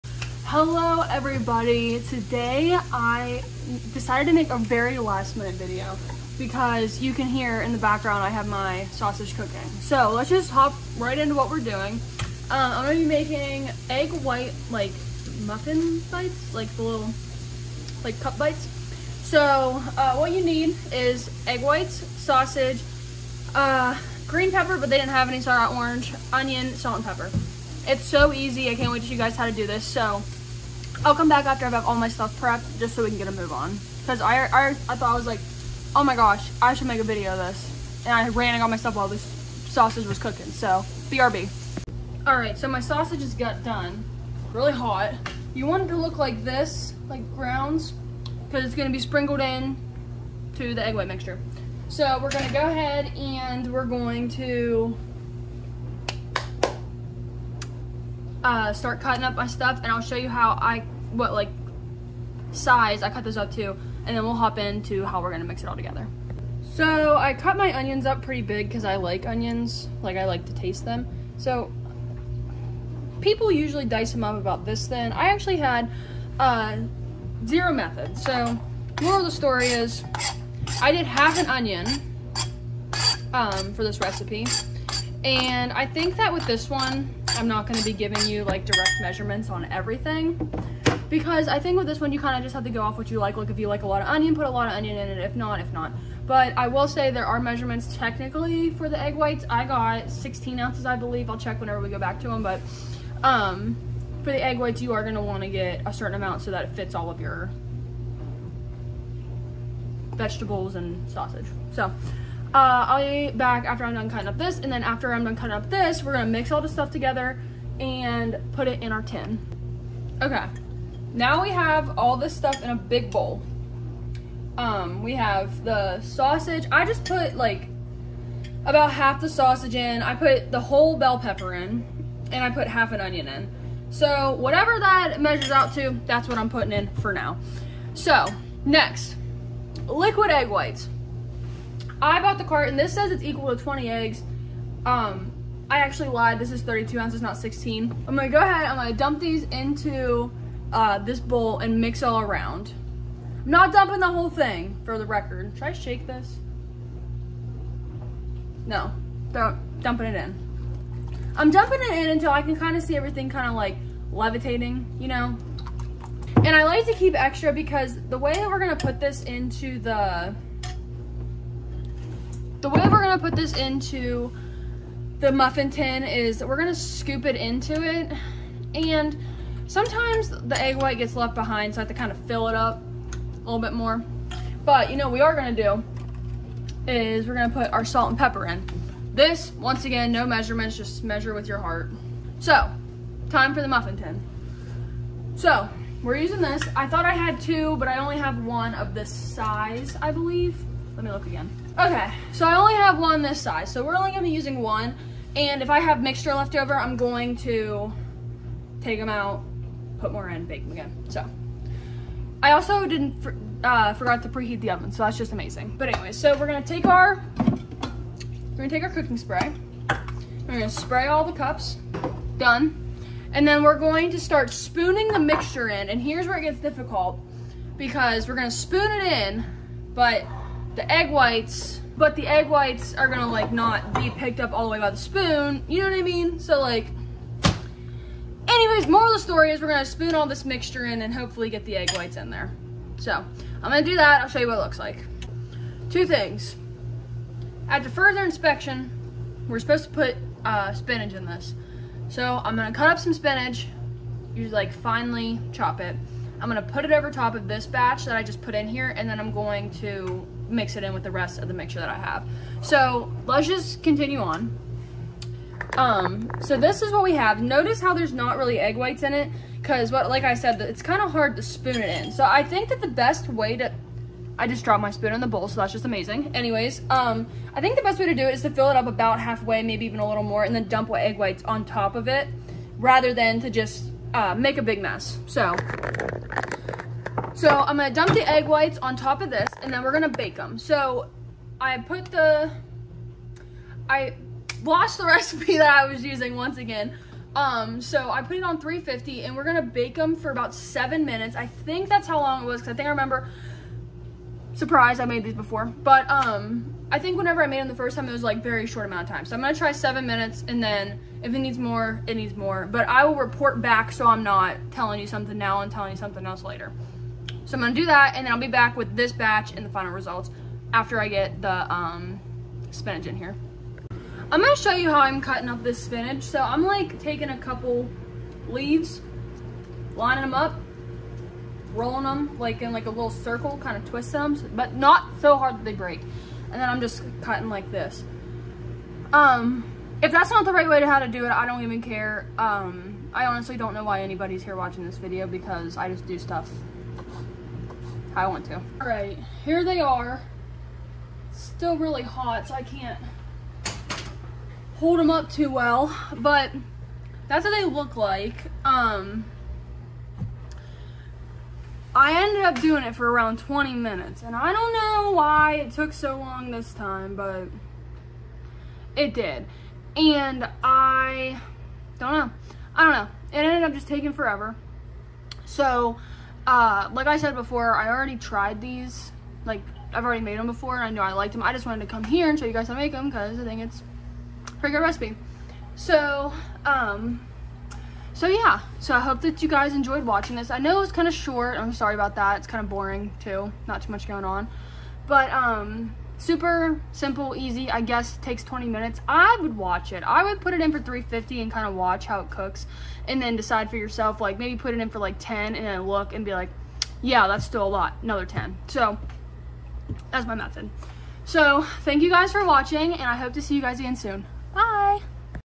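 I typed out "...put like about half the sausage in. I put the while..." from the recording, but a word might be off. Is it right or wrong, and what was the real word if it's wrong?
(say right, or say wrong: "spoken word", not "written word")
wrong: "whole", not "while".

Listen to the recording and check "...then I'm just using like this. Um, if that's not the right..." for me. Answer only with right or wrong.
wrong.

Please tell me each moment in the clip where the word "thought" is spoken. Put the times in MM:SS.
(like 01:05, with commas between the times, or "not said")
00:34, 03:16.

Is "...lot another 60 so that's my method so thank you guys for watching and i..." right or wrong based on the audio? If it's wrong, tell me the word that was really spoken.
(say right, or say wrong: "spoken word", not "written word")
wrong: "10", not "60".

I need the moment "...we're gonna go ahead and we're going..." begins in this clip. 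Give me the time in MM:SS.
00:52.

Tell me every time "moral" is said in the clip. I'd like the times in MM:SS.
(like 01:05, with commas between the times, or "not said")
01:19, 03:58.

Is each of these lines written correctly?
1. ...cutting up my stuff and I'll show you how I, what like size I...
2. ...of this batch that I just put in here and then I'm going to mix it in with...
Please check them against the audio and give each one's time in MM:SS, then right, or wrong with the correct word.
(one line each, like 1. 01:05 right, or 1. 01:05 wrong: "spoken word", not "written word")
1. 00:59 right
2. 04:17 right.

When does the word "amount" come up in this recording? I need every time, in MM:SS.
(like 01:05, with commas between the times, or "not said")
01:46, 05:08.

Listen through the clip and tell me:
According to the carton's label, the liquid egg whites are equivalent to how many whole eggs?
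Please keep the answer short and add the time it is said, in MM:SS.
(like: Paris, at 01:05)
20, at 02:23.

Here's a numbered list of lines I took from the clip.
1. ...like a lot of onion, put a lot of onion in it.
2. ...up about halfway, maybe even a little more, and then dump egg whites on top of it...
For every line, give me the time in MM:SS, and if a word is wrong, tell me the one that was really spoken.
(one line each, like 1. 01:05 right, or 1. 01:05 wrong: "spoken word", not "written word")
1. 01:33 right
2. 04:38 right.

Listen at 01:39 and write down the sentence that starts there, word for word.
I got 16 ounces, I believe.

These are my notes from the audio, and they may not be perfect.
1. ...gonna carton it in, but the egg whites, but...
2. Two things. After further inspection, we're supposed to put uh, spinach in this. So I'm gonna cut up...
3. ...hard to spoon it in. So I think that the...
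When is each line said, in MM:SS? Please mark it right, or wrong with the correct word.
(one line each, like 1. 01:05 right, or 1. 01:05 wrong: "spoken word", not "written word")
1. 03:48 wrong: "spoon", not "carton"
2. 04:05 right
3. 04:31 right.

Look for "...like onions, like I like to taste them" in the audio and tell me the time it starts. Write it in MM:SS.
01:08.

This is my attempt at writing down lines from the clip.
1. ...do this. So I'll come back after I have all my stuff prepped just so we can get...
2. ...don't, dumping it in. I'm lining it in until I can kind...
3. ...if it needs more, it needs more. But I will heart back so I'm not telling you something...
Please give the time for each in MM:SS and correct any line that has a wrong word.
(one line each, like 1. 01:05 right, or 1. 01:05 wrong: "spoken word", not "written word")
1. 00:29 right
2. 02:39 wrong: "dumping", not "lining"
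3. 05:11 wrong: "report", not "heart".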